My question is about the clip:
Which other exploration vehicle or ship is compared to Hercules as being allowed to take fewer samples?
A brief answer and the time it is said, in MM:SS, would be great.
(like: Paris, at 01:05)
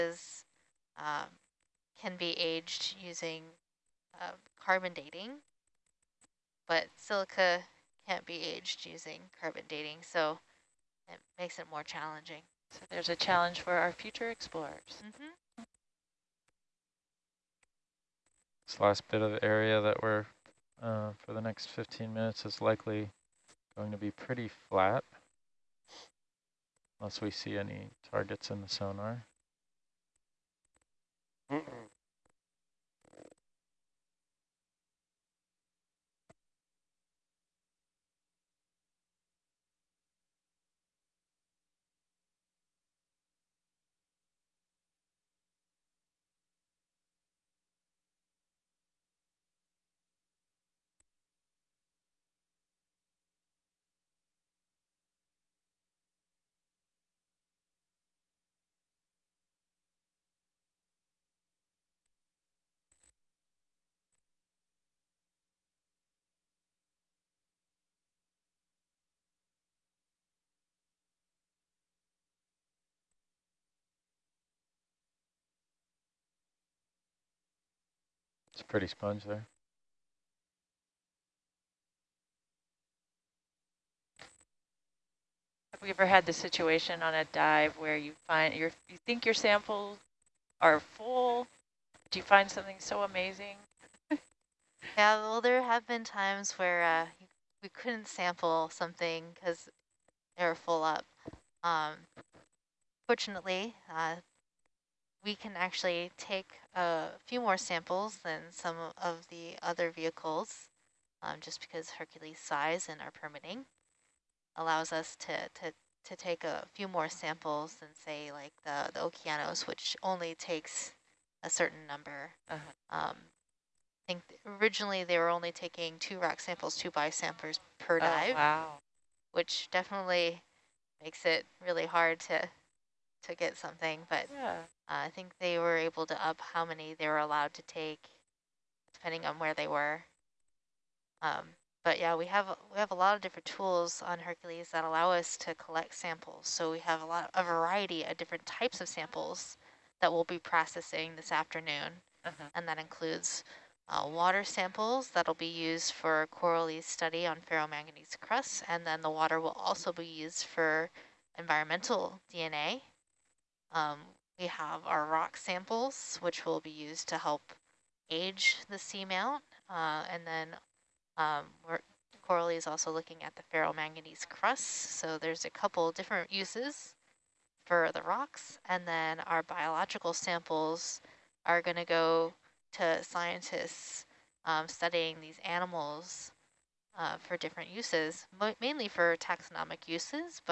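Okeanos, at 01:58.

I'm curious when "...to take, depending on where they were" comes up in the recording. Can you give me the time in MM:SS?
02:17.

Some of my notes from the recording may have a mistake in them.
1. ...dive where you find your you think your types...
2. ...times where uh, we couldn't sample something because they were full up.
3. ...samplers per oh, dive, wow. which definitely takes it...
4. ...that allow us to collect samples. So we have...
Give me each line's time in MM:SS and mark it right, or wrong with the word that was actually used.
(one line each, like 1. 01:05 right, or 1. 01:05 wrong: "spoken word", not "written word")
1. 01:27 wrong: "samples", not "types"
2. 01:36 right
3. 02:07 wrong: "makes", not "takes"
4. 02:24 right.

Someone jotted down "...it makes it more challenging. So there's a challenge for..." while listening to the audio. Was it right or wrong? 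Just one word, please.
right.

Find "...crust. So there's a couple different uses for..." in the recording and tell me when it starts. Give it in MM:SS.
02:54.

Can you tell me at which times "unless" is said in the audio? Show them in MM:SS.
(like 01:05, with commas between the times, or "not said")
00:26.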